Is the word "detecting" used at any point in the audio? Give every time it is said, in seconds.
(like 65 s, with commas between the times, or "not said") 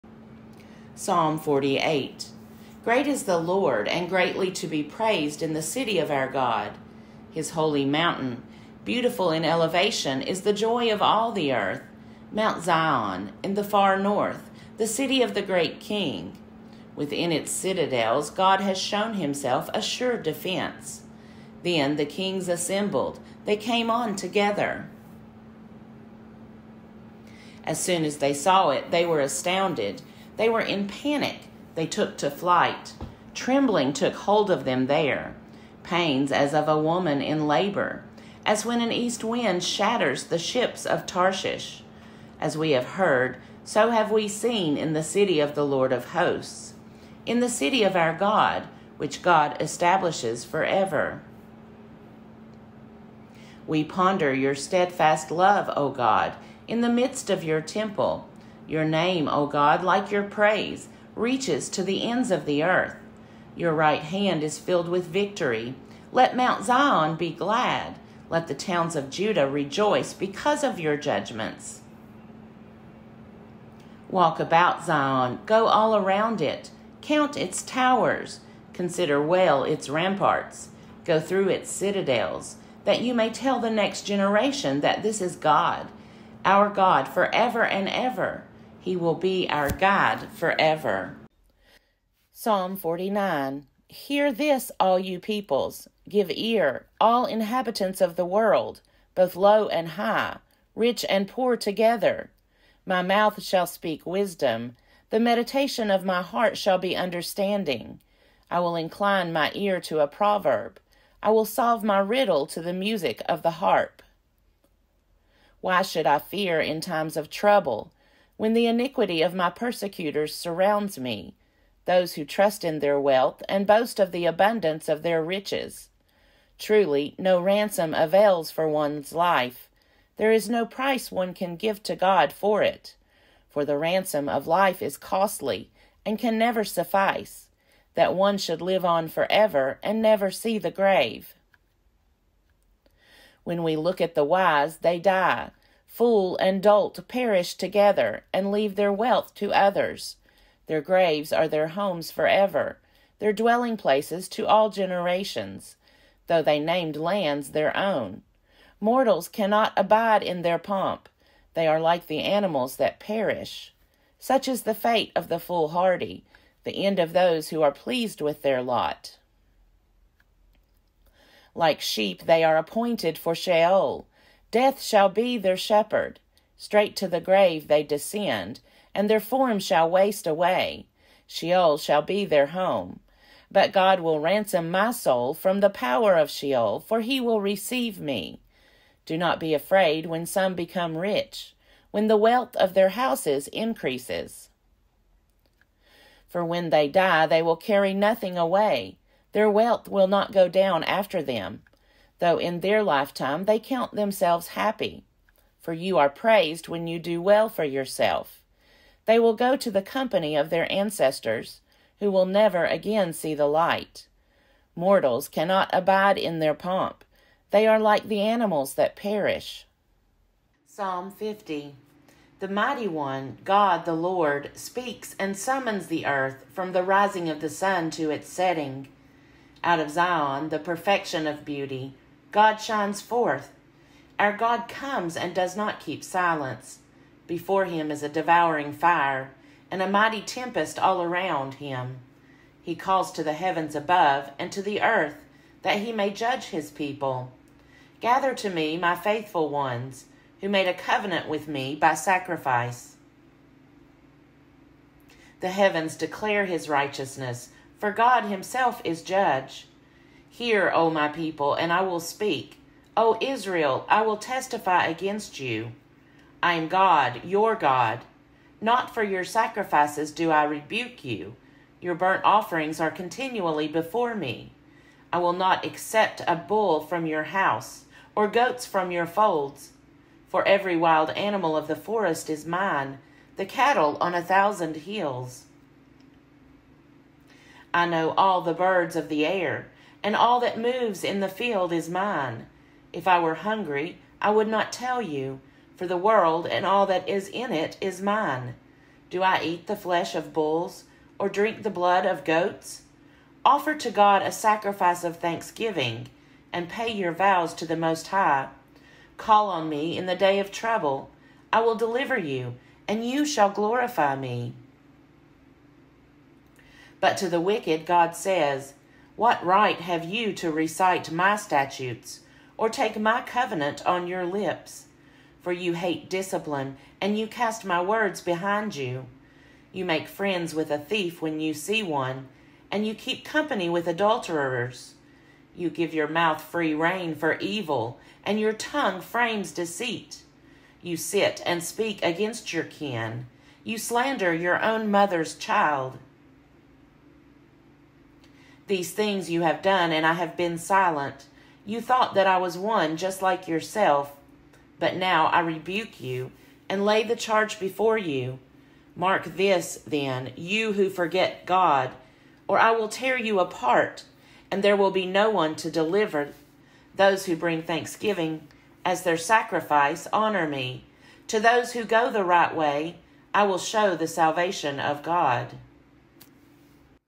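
not said.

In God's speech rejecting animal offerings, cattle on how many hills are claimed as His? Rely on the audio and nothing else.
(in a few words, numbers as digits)
1000.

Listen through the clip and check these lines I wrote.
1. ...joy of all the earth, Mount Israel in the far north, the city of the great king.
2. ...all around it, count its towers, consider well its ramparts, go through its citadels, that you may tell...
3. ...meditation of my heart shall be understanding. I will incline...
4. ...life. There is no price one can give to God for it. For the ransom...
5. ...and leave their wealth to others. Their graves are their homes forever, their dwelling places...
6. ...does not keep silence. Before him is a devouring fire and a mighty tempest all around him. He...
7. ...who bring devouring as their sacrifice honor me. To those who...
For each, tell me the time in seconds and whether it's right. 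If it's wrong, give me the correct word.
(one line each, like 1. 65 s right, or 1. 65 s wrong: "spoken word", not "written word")
1. 10 s wrong: "Zion", not "Israel"
2. 75 s right
3. 105 s right
4. 129 s right
5. 148 s right
6. 235 s right
7. 367 s wrong: "thanksgiving", not "devouring".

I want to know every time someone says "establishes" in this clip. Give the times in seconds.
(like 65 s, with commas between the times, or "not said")
49 s.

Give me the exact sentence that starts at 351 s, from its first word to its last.
You thought that I was one just like yourself, but now I rebuke you and lay the charge before you.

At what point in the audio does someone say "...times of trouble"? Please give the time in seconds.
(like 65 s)
116 s.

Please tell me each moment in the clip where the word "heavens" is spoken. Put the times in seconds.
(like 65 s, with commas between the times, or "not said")
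243 s, 255 s.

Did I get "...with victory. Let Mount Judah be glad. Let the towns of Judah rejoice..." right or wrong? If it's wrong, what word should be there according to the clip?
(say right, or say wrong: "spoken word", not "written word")
wrong: "Zion", not "Judah".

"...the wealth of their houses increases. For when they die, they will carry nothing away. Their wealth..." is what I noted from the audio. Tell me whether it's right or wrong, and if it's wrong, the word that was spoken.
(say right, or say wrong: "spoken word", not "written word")
right.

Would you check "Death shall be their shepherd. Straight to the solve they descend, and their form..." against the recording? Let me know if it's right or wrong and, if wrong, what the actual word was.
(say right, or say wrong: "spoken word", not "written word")
wrong: "grave", not "solve".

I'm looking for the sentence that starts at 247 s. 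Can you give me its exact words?
Gather to me my faithful ones who made a covenant with me by sacrifice.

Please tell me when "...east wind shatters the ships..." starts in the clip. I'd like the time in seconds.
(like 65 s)
38 s.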